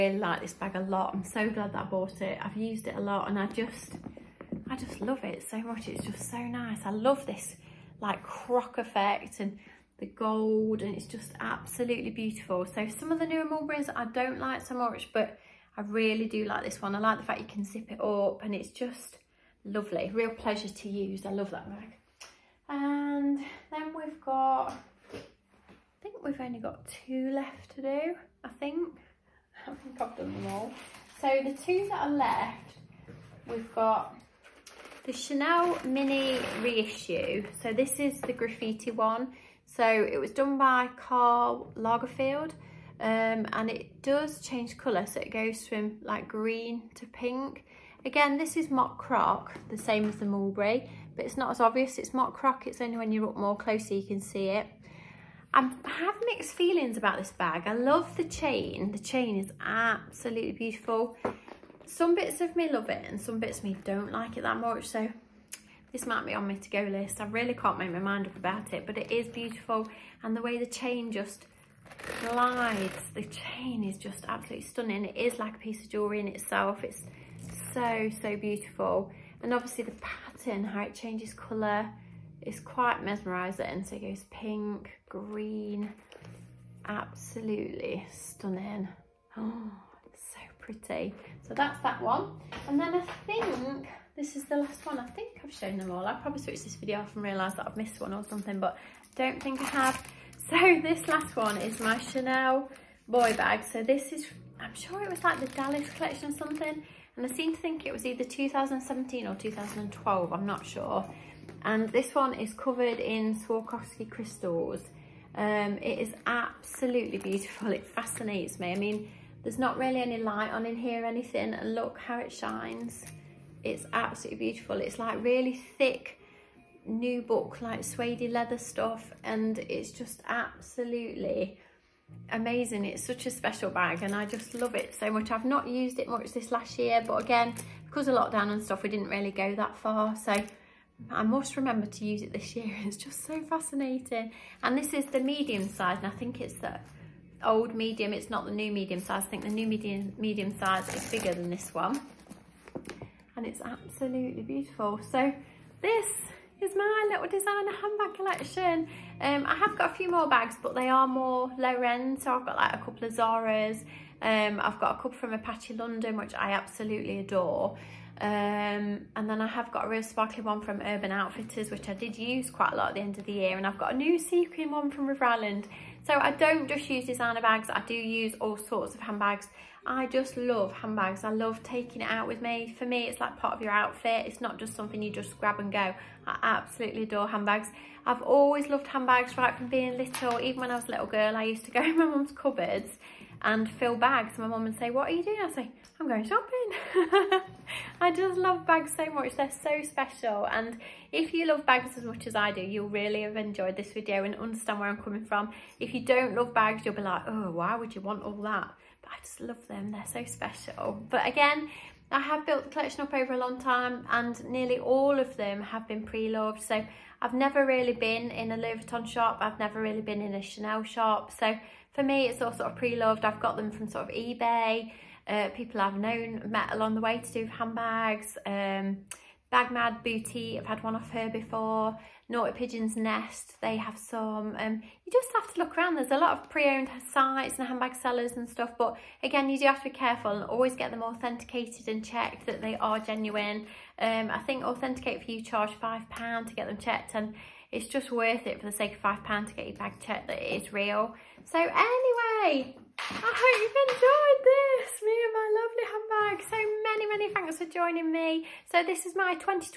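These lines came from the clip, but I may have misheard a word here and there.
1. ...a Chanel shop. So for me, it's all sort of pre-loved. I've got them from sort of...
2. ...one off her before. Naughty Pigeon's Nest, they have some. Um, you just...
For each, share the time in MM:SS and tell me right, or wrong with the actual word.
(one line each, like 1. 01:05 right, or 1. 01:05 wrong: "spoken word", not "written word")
1. 03:40 right
2. 03:50 right.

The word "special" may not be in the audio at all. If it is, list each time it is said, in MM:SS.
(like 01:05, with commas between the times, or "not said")
02:13, 03:19, 03:30.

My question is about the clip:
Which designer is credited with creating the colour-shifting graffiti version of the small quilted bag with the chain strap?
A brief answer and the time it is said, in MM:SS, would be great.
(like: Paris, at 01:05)
Karl Lagerfeld, at 00:40.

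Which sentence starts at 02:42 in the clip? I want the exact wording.
So I've got like a couple of Zara's.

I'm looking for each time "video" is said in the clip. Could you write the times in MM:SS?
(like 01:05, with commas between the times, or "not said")
01:36, 03:23.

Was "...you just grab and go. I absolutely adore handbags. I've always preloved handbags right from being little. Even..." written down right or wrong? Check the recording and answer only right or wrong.
wrong.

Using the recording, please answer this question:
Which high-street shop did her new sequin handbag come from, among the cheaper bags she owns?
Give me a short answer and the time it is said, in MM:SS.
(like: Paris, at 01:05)
River Island, at 02:55.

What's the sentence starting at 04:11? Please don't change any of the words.
So anyway, I hope you've enjoyed this, me and my lovely handbag.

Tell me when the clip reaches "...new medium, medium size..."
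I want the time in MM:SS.
02:29.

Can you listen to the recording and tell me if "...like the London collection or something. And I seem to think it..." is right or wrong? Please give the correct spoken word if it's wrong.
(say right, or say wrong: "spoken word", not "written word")
wrong: "Dallas", not "London".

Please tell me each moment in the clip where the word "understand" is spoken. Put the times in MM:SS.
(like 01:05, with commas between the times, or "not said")
03:24.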